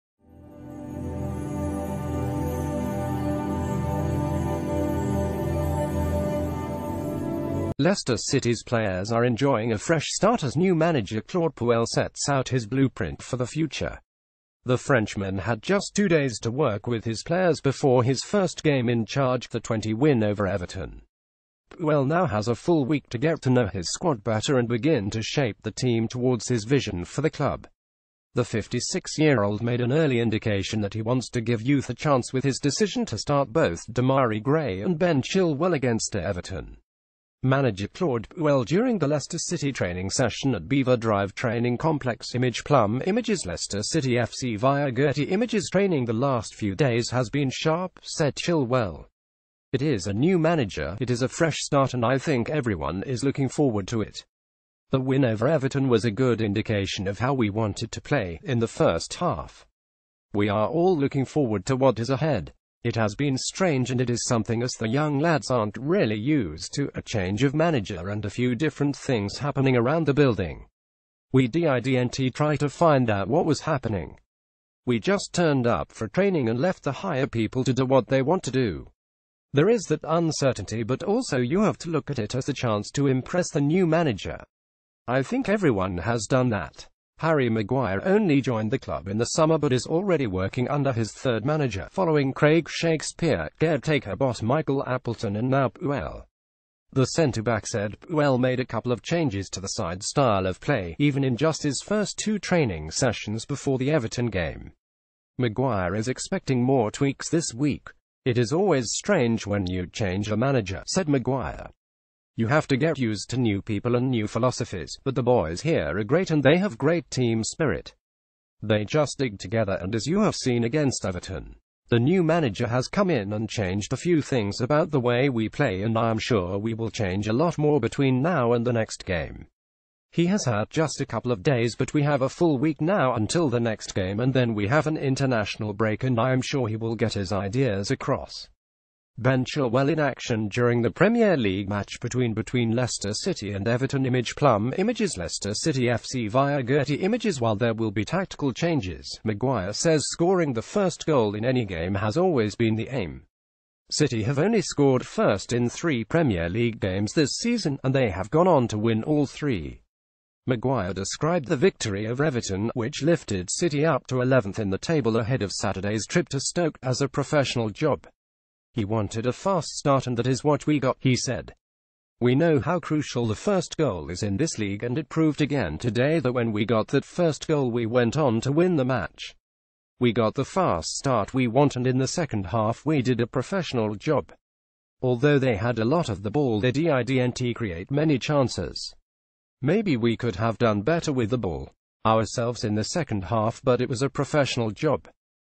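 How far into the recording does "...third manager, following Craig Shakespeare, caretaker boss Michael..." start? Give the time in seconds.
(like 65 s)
91 s.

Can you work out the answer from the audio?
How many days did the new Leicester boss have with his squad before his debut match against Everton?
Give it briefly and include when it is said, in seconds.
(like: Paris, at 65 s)
2, at 15 s.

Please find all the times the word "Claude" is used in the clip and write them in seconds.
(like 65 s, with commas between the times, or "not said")
11 s, 37 s.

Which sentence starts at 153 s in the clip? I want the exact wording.
City have only scored first in three Premier League games this season, and they have gone on to win all three.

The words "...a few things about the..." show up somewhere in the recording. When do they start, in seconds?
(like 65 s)
123 s.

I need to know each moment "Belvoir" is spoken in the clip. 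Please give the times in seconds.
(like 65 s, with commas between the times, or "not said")
40 s.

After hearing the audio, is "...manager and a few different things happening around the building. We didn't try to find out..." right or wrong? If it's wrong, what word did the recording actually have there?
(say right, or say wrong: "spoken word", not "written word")
right.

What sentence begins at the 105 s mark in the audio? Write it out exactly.
Maguire is expecting more tweaks this week.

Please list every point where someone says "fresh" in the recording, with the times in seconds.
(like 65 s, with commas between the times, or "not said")
9 s, 51 s.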